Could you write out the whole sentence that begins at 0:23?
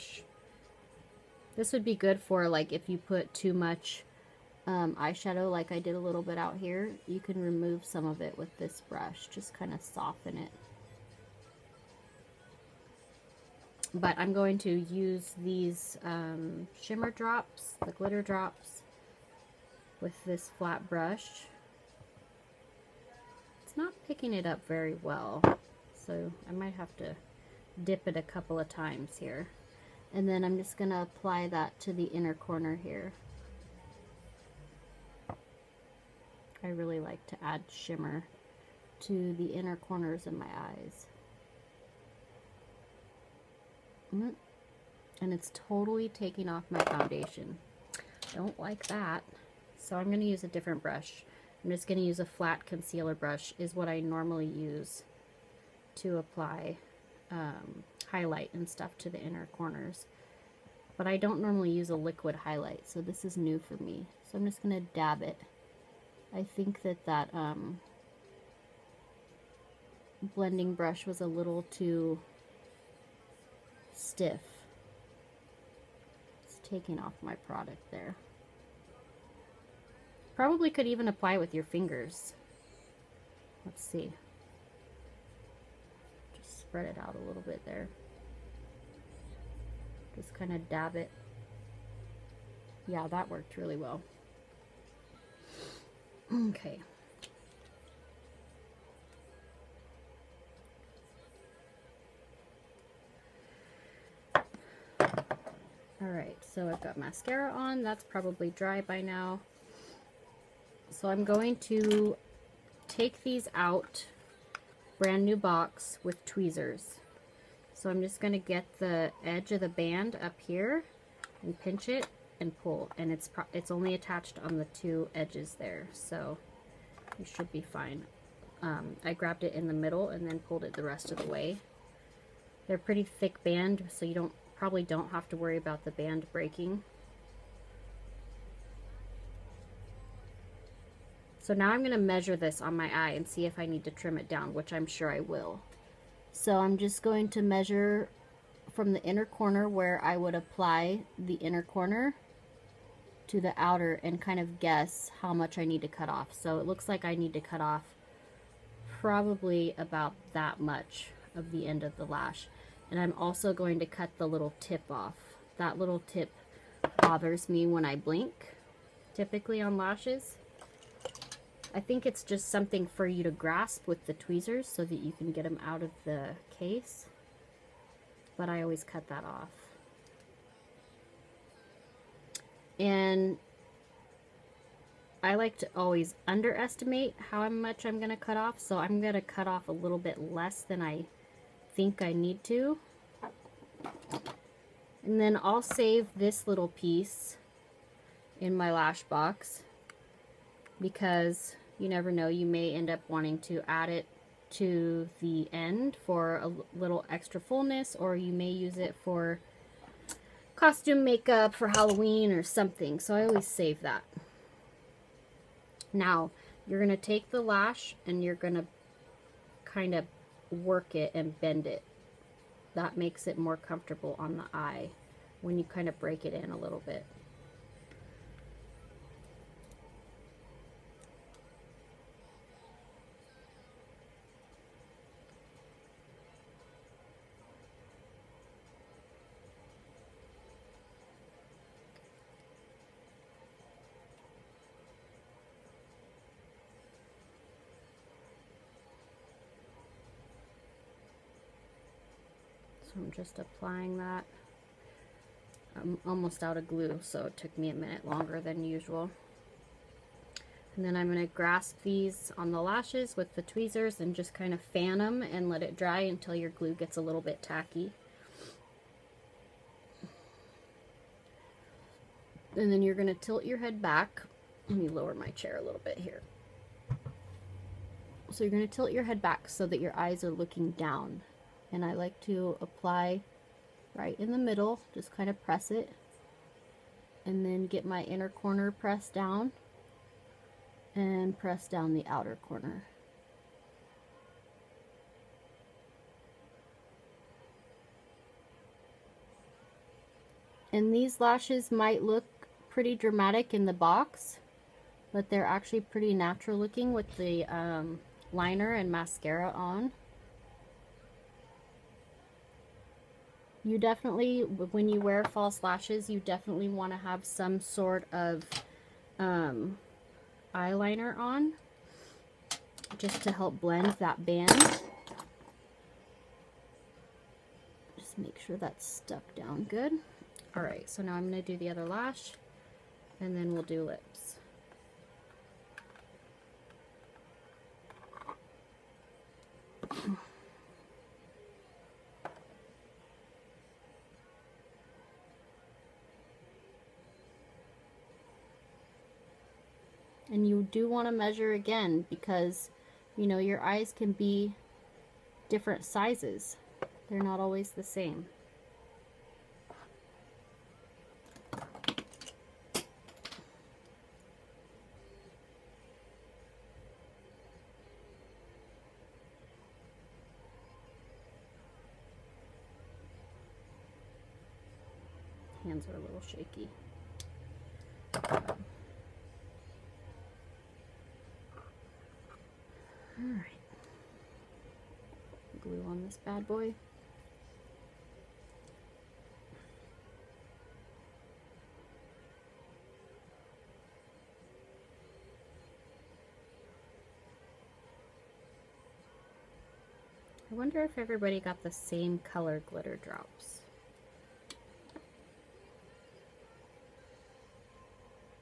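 It's not picking it up very well, so I might have to dip it a couple of times here.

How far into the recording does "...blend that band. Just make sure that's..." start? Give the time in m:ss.
5:23.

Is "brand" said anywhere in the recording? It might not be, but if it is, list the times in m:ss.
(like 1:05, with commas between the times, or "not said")
1:54.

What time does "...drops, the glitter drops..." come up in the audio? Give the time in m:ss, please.
0:17.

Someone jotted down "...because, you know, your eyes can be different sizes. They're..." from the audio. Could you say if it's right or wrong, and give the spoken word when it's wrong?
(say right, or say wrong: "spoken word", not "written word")
right.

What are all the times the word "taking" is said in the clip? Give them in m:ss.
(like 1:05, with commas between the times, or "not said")
0:46, 1:16.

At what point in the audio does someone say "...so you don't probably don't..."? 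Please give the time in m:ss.
2:13.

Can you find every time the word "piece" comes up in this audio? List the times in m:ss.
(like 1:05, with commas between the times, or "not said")
3:16.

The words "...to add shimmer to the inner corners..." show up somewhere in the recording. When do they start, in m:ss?
0:37.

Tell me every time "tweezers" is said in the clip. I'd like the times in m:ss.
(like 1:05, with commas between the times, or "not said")
1:56, 2:54, 4:23.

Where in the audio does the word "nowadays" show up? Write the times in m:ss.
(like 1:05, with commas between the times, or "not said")
not said.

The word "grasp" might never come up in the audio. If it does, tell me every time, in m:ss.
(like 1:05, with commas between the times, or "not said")
2:53, 4:21.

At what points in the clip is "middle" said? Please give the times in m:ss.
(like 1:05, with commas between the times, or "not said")
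2:09, 4:44.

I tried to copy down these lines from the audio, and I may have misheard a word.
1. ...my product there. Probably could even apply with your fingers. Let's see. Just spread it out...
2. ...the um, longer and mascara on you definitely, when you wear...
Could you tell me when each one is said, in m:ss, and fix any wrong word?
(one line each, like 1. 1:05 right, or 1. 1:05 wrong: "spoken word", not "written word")
1. 1:17 right
2. 5:07 wrong: "liner", not "longer".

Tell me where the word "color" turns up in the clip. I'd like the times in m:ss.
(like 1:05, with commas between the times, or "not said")
6:42.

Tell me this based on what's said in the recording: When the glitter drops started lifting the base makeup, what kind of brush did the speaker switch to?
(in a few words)
Flat concealer brush.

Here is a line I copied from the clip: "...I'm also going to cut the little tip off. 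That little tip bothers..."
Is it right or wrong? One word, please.
right.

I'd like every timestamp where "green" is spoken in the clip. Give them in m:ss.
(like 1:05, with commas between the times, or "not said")
not said.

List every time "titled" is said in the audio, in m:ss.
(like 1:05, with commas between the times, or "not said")
not said.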